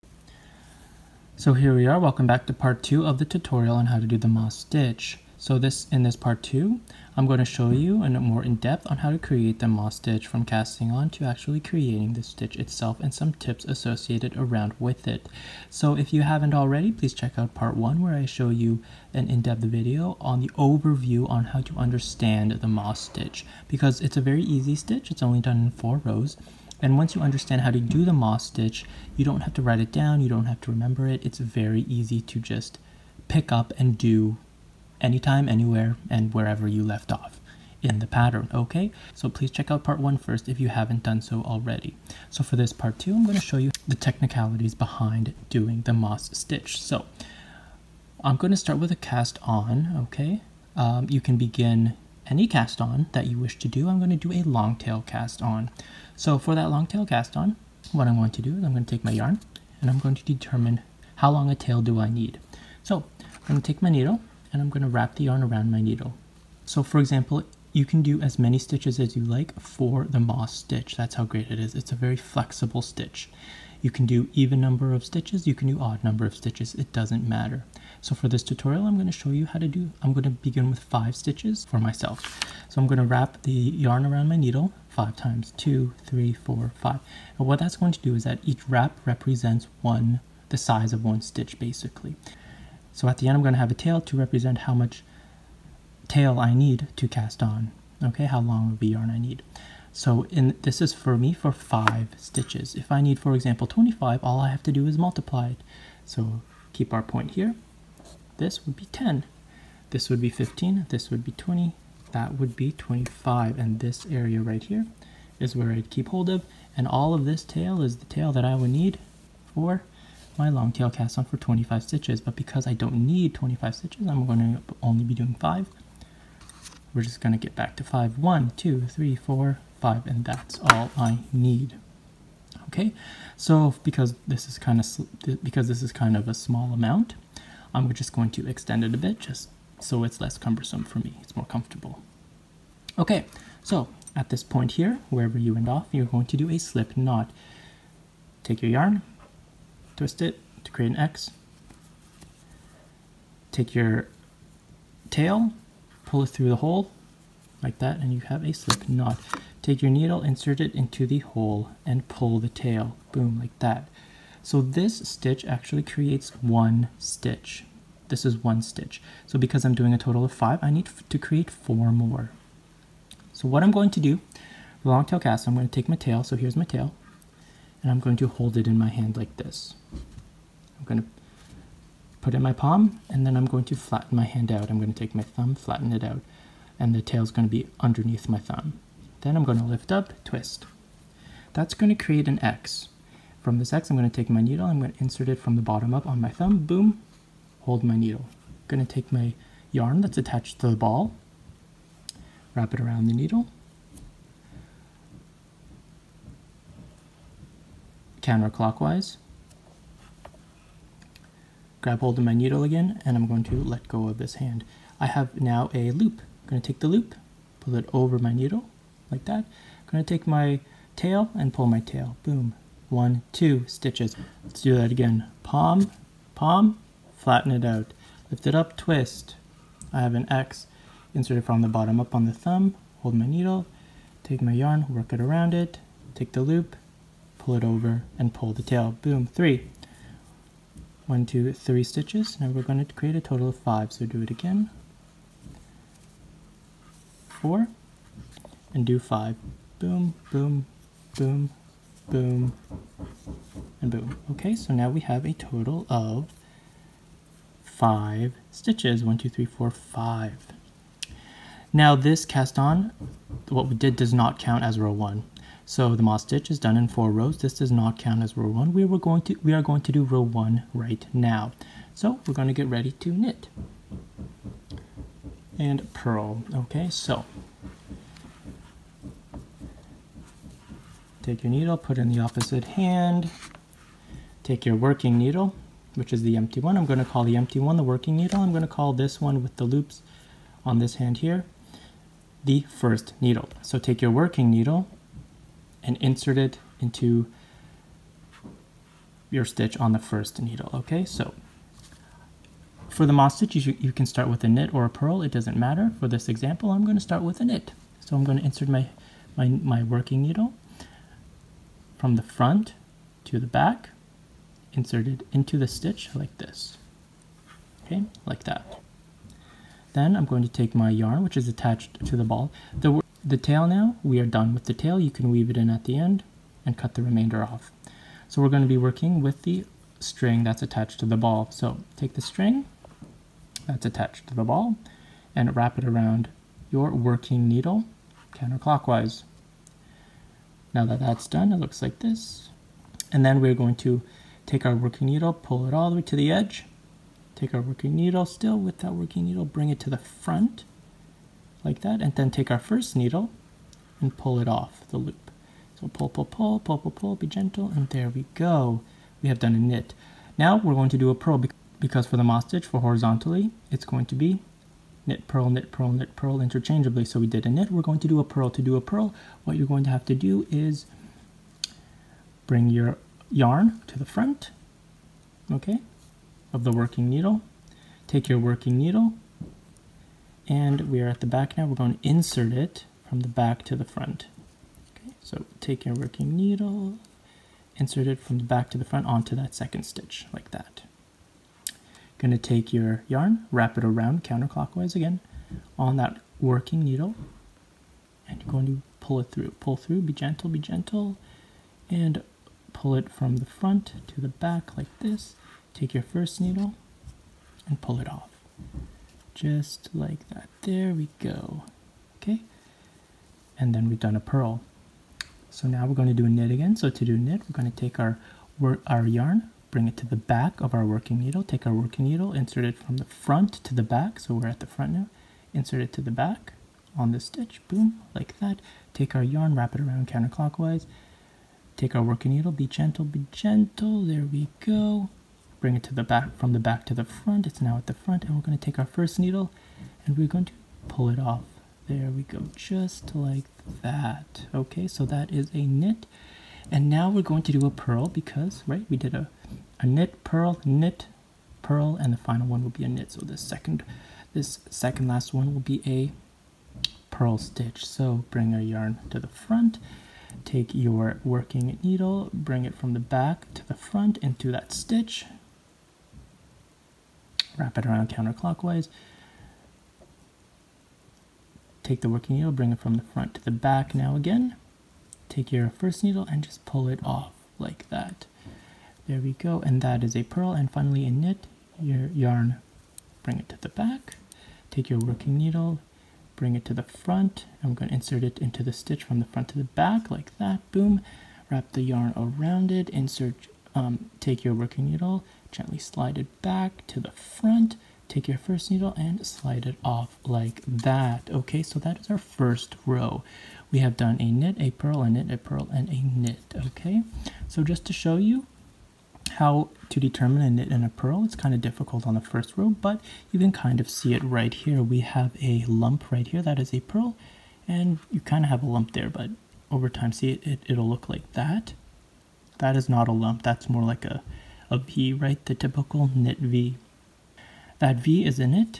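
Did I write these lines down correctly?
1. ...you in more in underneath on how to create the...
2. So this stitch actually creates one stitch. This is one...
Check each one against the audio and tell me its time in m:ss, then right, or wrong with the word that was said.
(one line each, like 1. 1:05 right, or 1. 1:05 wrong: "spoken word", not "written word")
1. 0:07 wrong: "depth", not "underneath"
2. 2:44 right.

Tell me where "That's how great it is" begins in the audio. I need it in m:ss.
1:10.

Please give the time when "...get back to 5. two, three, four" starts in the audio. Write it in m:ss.
2:07.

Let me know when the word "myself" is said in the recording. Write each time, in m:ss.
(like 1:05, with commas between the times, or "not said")
1:21.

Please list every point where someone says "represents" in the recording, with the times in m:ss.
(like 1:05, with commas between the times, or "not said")
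1:29, 1:34.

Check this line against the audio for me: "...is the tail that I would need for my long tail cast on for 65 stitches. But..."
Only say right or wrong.
wrong.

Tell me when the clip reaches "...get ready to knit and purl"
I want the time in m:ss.
4:32.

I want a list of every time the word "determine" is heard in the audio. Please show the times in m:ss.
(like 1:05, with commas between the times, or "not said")
1:00, 8:29.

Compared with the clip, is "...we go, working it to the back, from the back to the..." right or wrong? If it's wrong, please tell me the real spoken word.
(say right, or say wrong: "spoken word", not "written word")
wrong: "bring", not "working".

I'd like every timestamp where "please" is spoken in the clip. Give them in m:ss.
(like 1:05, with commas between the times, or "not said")
0:16, 0:39.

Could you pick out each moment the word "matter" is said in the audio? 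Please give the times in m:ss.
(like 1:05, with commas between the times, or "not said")
1:17, 5:05.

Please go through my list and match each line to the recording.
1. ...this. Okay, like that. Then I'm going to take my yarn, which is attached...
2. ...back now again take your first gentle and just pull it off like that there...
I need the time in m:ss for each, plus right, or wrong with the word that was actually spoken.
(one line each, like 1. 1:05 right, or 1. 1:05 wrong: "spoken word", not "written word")
1. 5:16 right
2. 7:53 wrong: "needle", not "gentle".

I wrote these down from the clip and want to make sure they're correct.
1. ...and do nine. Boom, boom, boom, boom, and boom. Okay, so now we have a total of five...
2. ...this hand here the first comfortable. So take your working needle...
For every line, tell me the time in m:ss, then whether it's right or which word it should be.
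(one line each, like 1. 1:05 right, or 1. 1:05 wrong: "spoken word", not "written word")
1. 4:08 wrong: "five", not "nine"
2. 4:50 wrong: "needle", not "comfortable".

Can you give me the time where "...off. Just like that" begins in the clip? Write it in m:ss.
6:48.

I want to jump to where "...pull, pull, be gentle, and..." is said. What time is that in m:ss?
5:56.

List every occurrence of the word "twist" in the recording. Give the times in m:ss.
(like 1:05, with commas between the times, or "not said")
2:29, 3:10, 3:48.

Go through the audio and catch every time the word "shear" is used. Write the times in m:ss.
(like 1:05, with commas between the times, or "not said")
not said.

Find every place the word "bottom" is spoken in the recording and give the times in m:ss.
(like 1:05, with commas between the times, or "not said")
3:15, 3:51.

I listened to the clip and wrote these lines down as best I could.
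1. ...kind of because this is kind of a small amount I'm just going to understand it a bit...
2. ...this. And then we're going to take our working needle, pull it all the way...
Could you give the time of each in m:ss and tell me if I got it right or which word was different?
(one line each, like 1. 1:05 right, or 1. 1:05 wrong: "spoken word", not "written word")
1. 2:14 wrong: "extend", not "understand"
2. 5:42 right.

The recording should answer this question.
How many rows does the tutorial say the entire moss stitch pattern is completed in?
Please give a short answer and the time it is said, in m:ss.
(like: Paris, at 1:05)
4, at 0:25.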